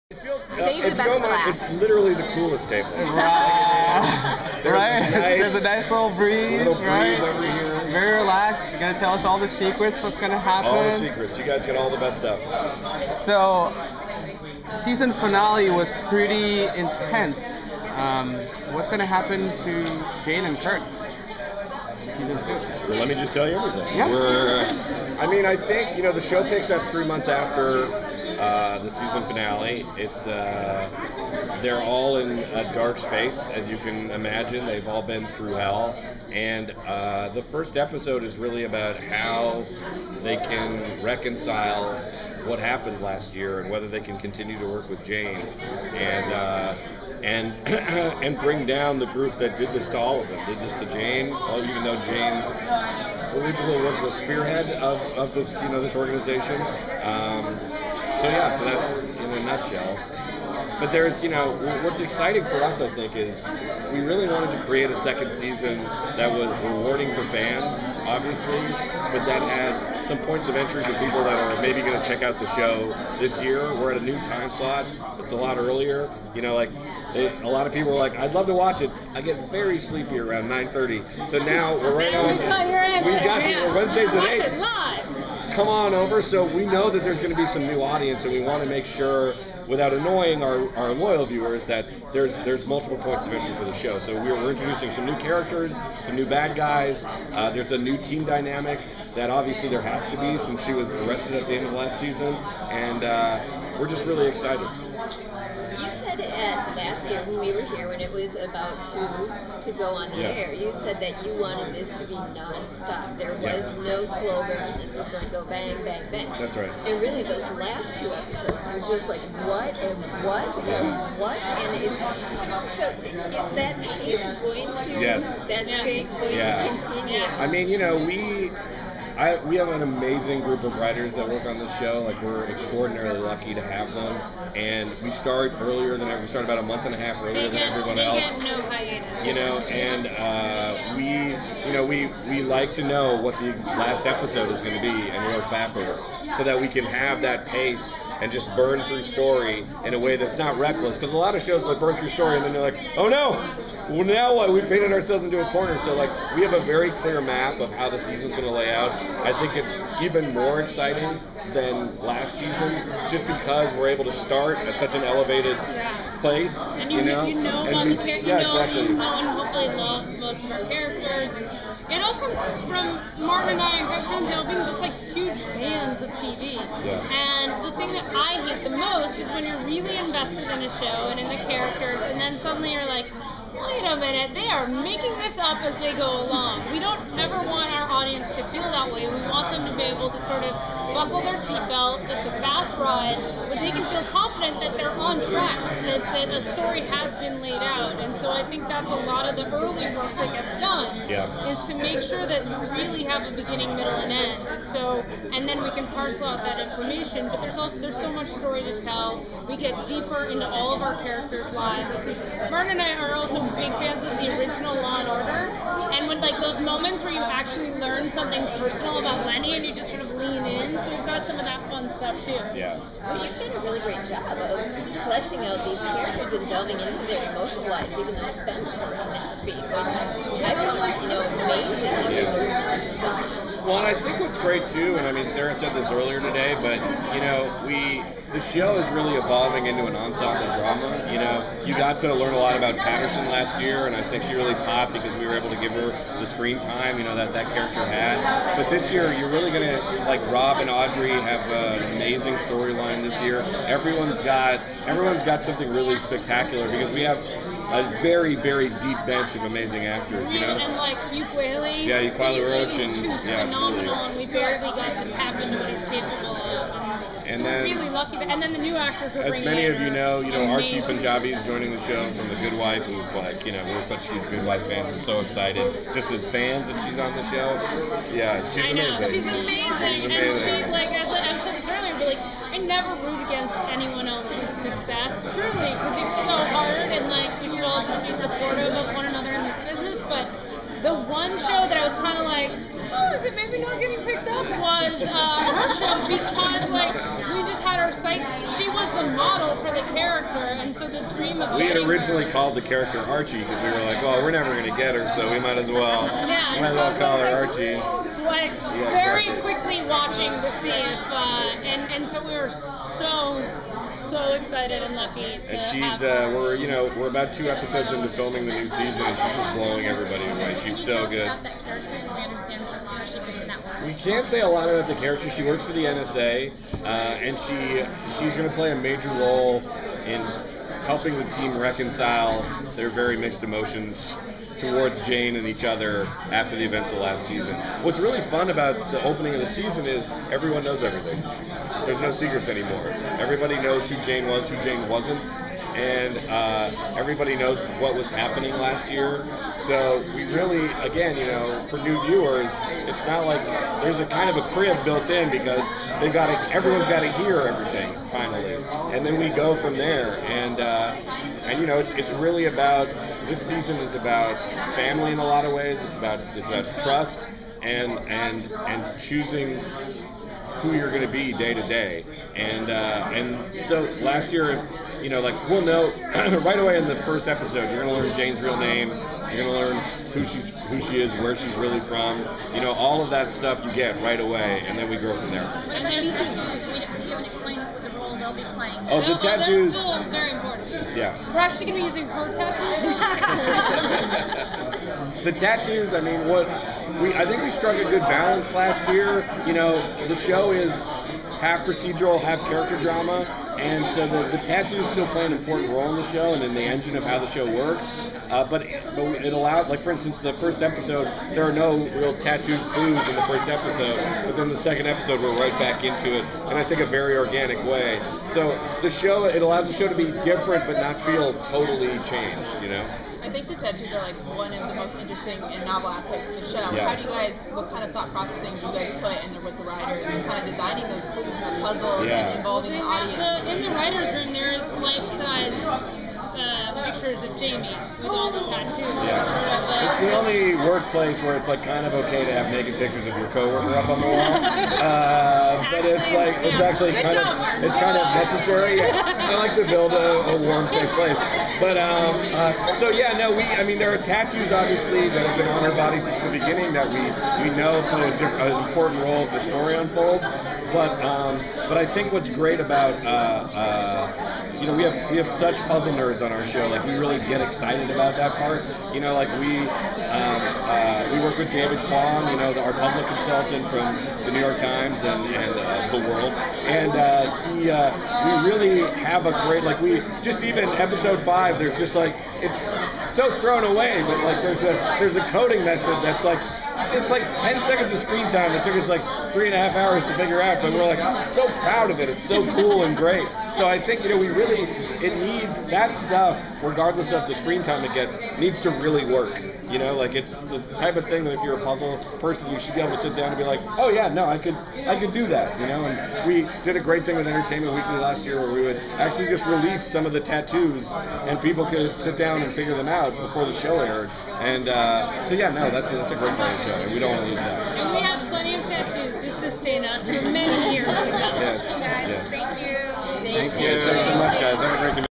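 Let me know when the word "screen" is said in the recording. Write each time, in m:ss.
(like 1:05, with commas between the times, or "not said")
4:06, 8:07, 8:17.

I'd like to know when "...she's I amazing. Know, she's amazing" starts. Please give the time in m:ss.
4:38.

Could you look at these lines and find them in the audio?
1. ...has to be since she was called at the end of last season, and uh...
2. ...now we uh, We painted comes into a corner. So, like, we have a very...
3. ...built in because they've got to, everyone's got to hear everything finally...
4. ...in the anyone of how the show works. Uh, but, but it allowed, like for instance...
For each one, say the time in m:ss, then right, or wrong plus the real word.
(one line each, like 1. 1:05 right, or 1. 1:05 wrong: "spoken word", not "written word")
1. 1:39 wrong: "arrested", not "called"
2. 2:34 wrong: "ourselves", not "comes"
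3. 5:54 right
4. 6:46 wrong: "engine", not "anyone".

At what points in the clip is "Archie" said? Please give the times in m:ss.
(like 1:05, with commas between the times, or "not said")
4:30, 5:02, 5:07.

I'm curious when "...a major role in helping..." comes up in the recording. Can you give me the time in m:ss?
5:28.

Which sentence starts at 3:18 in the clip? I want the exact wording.
And so I think that's a lot of the early work that gets done yeah.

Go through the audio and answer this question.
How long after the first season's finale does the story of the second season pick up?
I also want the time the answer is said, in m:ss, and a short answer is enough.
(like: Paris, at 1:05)
3 months, at 0:26.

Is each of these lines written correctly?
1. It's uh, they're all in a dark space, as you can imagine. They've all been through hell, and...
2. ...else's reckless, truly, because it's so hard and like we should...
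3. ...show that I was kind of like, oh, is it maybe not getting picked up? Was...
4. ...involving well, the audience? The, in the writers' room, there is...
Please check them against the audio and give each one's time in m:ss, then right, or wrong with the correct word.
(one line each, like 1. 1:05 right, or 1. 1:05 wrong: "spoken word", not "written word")
1. 0:29 right
2. 4:44 wrong: "success", not "reckless"
3. 4:51 right
4. 7:12 right.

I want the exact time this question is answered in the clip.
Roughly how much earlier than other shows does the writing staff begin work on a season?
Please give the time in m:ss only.
2:16.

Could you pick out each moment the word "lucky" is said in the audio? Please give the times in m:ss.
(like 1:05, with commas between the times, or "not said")
2:13, 4:27, 5:14.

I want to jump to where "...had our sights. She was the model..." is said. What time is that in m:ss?
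4:57.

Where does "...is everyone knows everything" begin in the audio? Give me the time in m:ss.
5:39.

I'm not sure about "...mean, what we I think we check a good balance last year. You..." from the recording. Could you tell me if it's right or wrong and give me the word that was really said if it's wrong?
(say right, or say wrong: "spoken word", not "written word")
wrong: "struck", not "check".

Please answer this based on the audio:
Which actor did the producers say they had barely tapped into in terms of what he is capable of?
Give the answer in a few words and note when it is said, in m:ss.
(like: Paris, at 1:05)
Ukweli Roach, at 4:22.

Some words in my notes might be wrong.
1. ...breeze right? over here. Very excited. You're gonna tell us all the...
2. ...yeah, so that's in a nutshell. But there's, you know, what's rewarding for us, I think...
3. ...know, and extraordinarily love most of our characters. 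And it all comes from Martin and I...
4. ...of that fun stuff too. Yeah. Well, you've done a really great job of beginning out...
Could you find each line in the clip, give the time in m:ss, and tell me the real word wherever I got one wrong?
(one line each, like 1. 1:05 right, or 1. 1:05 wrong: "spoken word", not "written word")
1. 0:06 wrong: "relaxed", not "excited"
2. 0:58 wrong: "exciting", not "rewarding"
3. 2:48 wrong: "hopefully", not "extraordinarily"
4. 3:41 wrong: "fleshing", not "beginning".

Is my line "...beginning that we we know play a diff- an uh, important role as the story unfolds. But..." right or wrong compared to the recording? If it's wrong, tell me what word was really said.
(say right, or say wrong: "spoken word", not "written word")
right.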